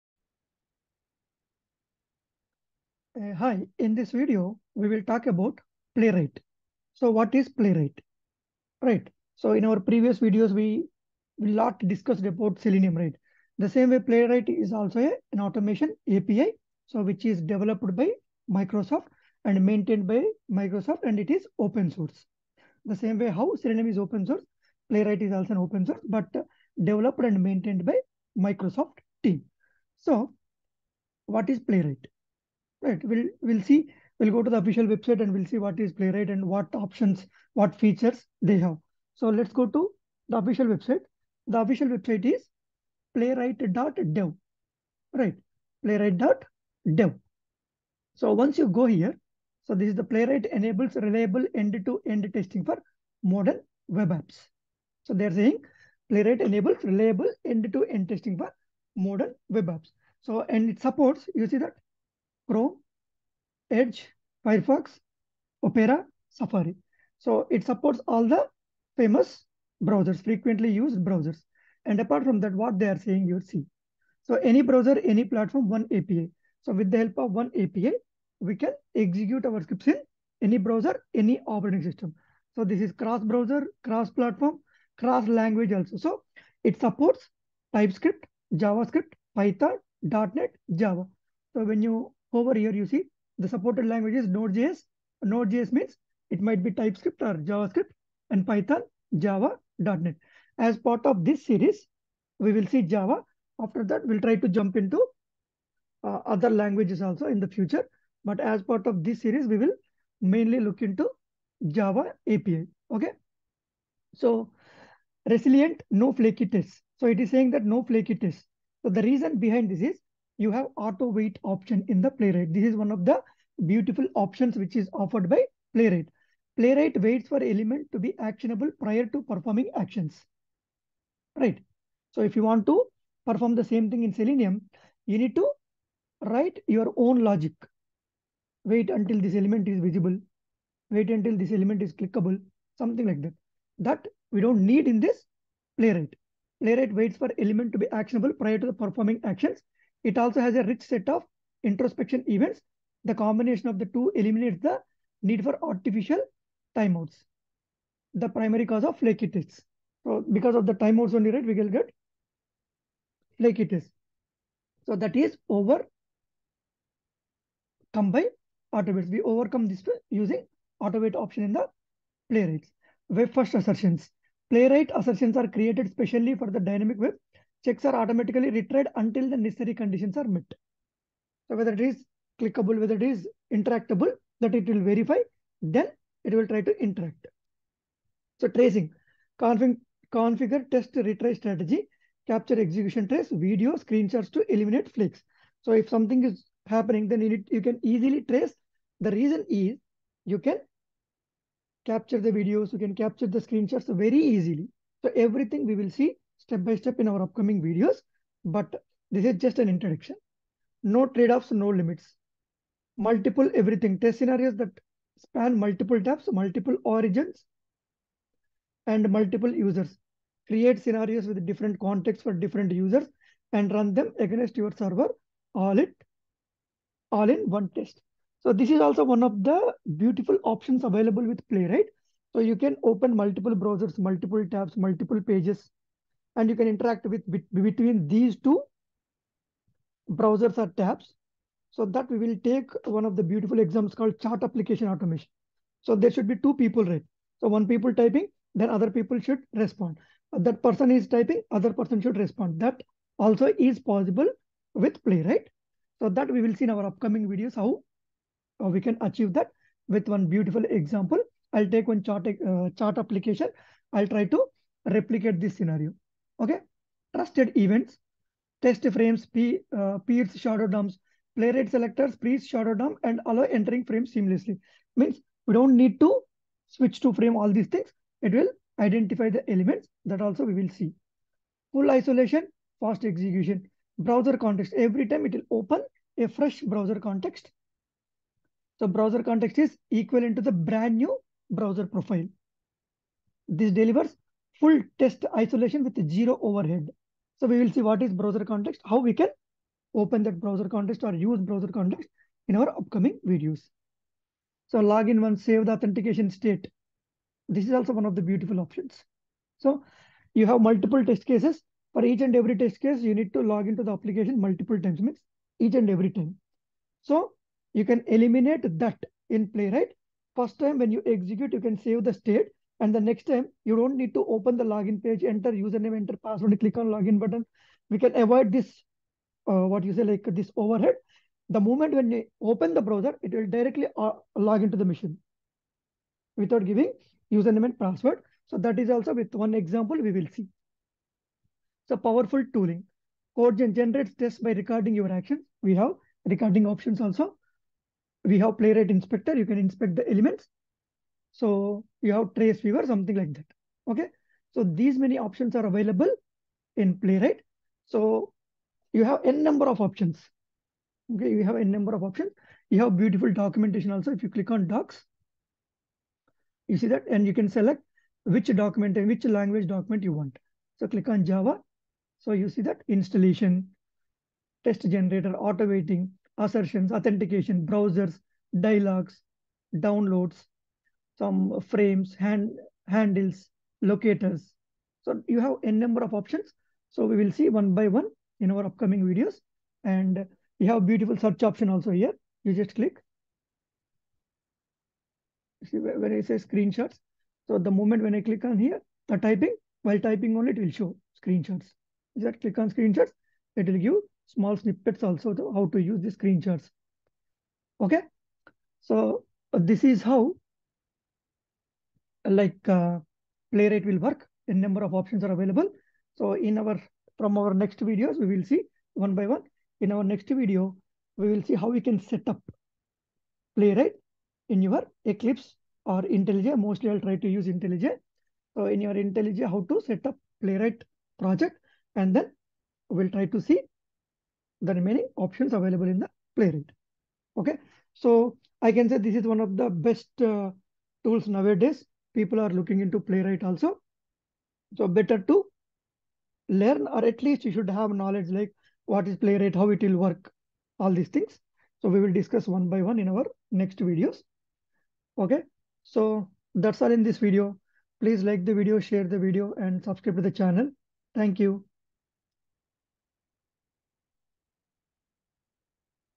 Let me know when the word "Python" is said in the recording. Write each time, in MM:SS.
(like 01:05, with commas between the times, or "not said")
01:29, 01:38.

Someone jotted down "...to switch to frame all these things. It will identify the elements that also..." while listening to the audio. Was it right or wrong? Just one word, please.
right.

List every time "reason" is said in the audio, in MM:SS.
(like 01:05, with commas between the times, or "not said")
01:59, 03:19.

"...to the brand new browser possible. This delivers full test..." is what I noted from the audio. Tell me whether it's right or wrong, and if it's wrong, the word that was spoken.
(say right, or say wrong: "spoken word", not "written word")
wrong: "profile", not "possible".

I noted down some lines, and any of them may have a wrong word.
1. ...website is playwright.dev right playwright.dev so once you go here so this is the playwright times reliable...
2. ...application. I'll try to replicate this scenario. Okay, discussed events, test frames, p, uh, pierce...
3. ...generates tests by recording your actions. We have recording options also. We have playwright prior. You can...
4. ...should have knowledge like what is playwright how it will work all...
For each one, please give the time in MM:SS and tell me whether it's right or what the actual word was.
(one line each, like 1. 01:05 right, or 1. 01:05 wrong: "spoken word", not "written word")
1. 00:41 wrong: "enables", not "times"
2. 04:22 wrong: "trusted", not "discussed"
3. 05:43 wrong: "inspector", not "prior"
4. 07:27 right.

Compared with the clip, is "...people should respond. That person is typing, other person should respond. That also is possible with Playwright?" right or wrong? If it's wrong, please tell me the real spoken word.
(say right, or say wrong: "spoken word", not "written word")
right.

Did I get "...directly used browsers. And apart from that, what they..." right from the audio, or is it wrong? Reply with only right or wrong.
wrong.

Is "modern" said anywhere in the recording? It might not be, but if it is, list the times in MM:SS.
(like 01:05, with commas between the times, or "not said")
00:53, 00:59.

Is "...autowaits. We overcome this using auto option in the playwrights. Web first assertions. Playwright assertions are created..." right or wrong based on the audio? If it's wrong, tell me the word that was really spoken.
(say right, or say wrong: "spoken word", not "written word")
right.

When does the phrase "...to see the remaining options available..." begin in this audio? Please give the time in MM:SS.
07:13.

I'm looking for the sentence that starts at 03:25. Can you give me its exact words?
So everything we will see step by step in our upcoming videos, but this is just an introduction.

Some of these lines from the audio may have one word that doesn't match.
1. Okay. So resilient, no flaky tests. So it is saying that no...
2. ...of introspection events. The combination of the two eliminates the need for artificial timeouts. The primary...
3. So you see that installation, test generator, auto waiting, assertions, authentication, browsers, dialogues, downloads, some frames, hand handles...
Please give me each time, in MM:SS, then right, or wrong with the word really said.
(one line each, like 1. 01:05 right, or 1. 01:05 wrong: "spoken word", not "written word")
1. 01:52 right
2. 02:31 right
3. 06:12 right.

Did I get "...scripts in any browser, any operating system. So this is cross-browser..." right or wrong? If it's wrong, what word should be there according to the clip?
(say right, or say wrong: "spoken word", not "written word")
right.